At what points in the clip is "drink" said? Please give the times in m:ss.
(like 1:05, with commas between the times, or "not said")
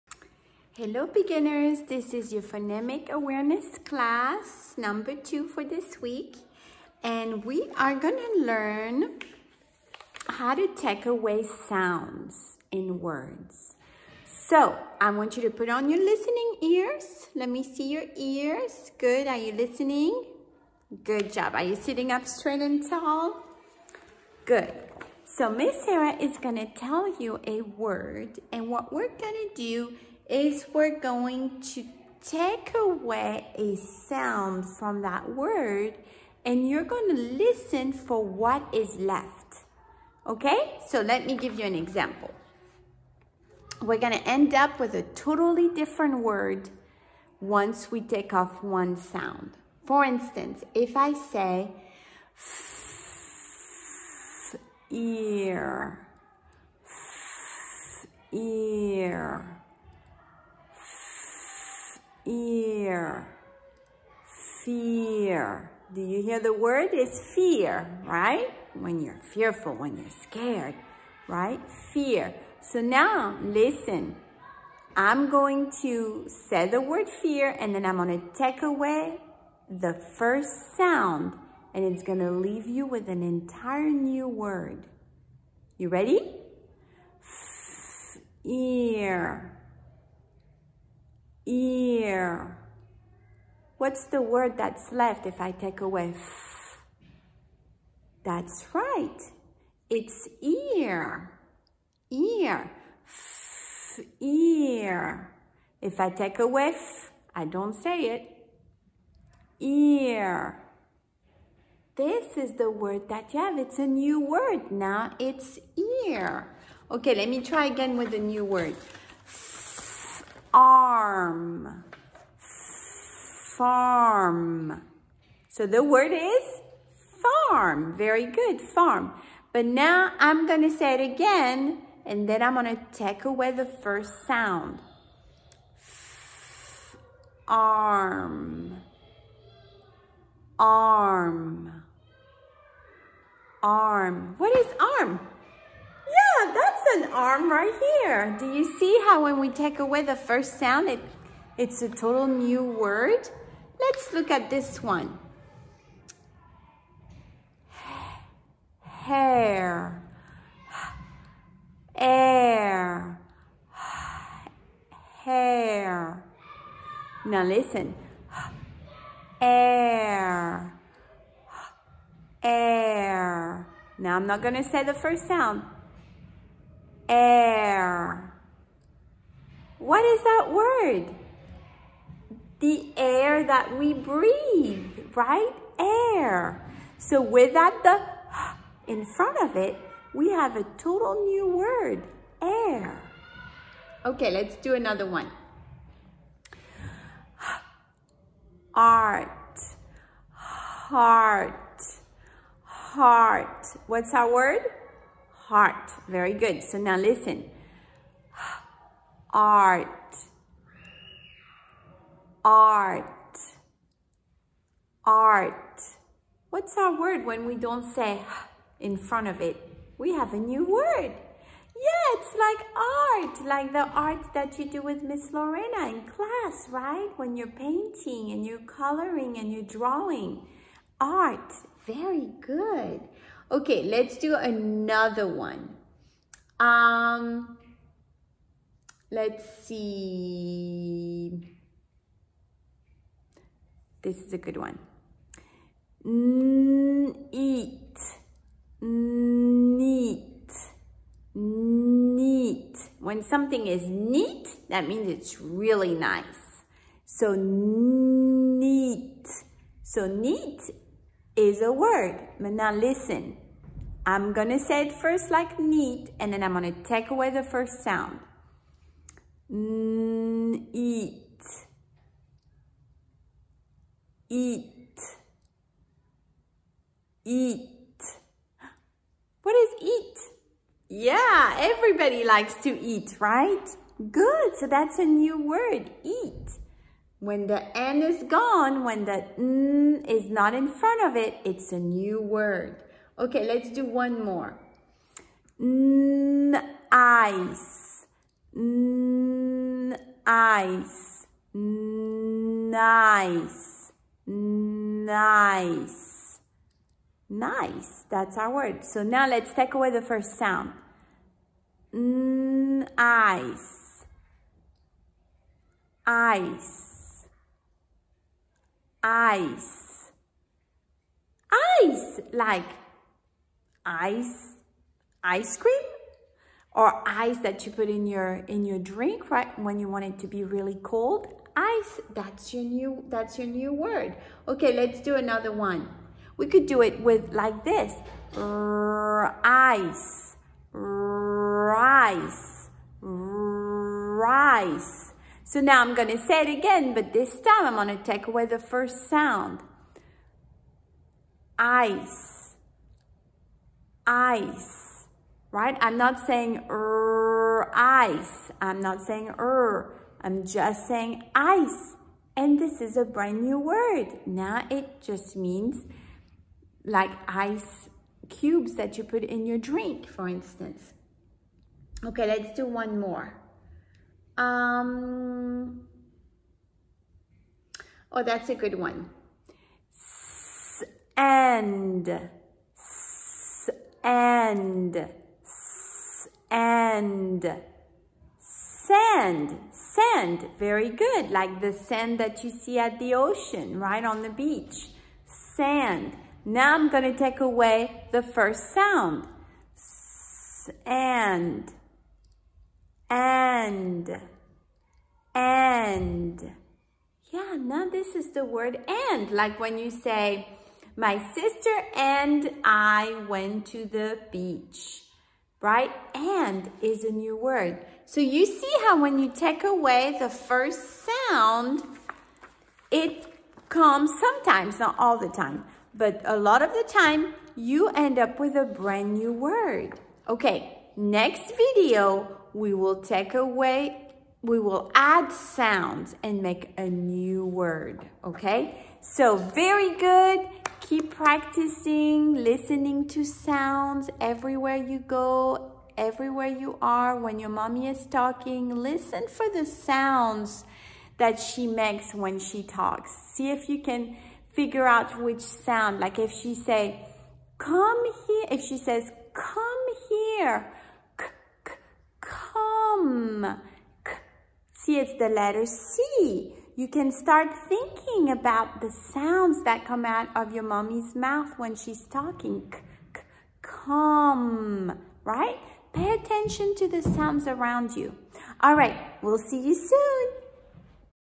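5:28, 6:09.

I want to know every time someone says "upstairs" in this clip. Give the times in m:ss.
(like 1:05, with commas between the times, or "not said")
not said.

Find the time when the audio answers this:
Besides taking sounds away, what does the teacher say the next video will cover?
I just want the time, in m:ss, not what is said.
7:14.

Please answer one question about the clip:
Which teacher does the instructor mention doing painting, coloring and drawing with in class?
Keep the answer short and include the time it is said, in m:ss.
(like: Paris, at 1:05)
Miss Lorena, at 3:45.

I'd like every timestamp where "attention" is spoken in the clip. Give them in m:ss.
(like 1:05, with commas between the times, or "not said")
7:56.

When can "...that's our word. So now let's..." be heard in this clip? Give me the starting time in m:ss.
5:08.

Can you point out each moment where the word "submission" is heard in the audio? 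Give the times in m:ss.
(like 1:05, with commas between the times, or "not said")
not said.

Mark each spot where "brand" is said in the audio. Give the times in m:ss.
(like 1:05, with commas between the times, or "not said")
6:03, 7:08.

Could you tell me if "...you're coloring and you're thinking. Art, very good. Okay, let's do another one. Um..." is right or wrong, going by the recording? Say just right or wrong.
wrong.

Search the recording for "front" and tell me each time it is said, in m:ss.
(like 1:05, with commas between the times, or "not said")
3:09, 3:38, 4:50.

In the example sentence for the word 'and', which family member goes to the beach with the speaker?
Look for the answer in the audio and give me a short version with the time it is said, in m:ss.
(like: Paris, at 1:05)
sister, at 6:50.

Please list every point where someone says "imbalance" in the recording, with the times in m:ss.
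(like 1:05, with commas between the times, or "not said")
not said.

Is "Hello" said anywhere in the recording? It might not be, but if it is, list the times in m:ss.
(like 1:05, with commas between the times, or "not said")
0:00.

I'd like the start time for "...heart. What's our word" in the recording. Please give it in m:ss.
3:22.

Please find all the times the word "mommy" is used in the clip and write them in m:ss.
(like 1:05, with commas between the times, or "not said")
7:27, 7:50.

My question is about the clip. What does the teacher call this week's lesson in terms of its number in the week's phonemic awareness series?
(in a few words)
class number two.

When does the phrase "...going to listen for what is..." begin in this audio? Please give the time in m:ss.
0:36.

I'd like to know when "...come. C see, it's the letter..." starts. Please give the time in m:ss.
7:42.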